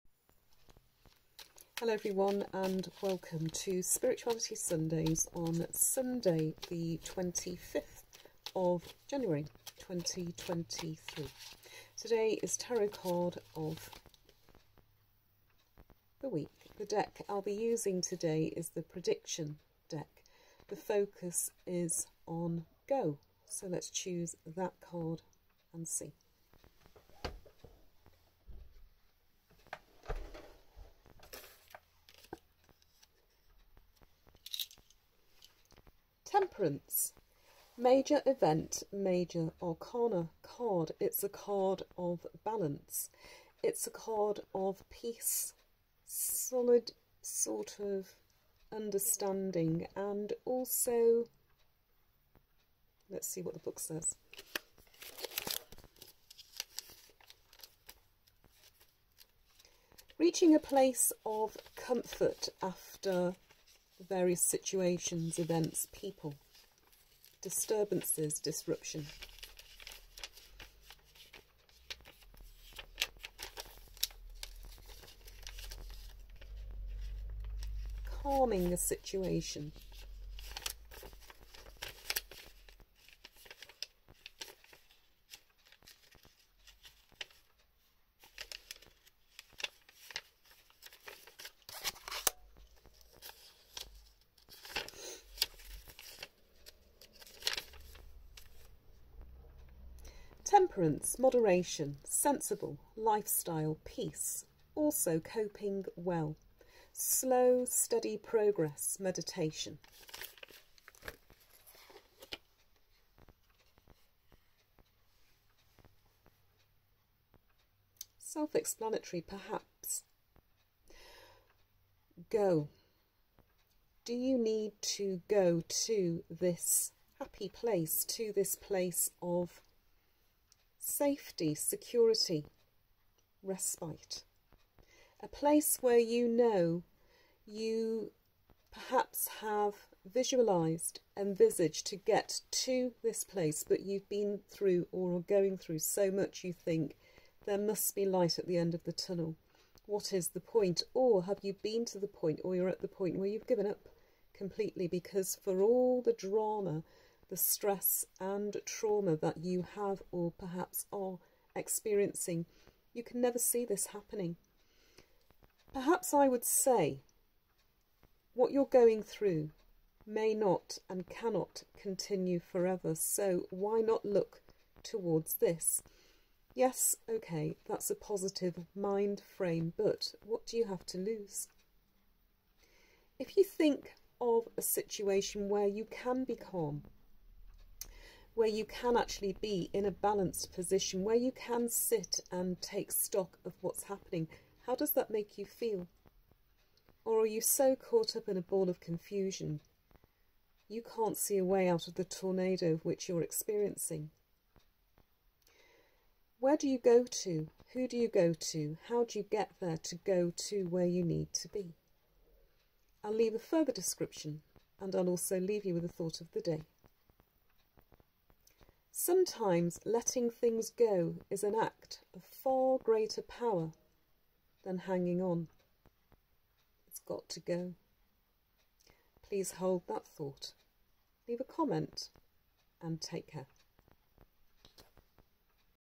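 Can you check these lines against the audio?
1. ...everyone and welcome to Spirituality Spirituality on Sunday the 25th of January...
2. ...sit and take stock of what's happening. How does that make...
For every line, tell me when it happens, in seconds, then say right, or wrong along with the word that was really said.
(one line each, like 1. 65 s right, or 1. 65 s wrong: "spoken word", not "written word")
1. 1 s wrong: "Sundays", not "Spirituality"
2. 191 s right.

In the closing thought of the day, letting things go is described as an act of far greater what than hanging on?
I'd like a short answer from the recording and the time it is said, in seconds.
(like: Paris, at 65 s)
power, at 223 s.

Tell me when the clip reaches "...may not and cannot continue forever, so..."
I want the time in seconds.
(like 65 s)
170 s.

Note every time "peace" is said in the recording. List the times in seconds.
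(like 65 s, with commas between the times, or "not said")
44 s, 103 s.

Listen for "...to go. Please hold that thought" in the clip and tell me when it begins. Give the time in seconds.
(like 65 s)
227 s.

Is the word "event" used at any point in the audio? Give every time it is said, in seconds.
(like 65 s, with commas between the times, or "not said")
38 s, 65 s.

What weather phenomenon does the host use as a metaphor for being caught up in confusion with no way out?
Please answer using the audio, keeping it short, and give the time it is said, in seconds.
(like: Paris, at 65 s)
tornado, at 202 s.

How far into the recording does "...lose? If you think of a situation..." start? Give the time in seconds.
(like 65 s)
180 s.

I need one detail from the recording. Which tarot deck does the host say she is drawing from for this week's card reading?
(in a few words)
Prediction deck.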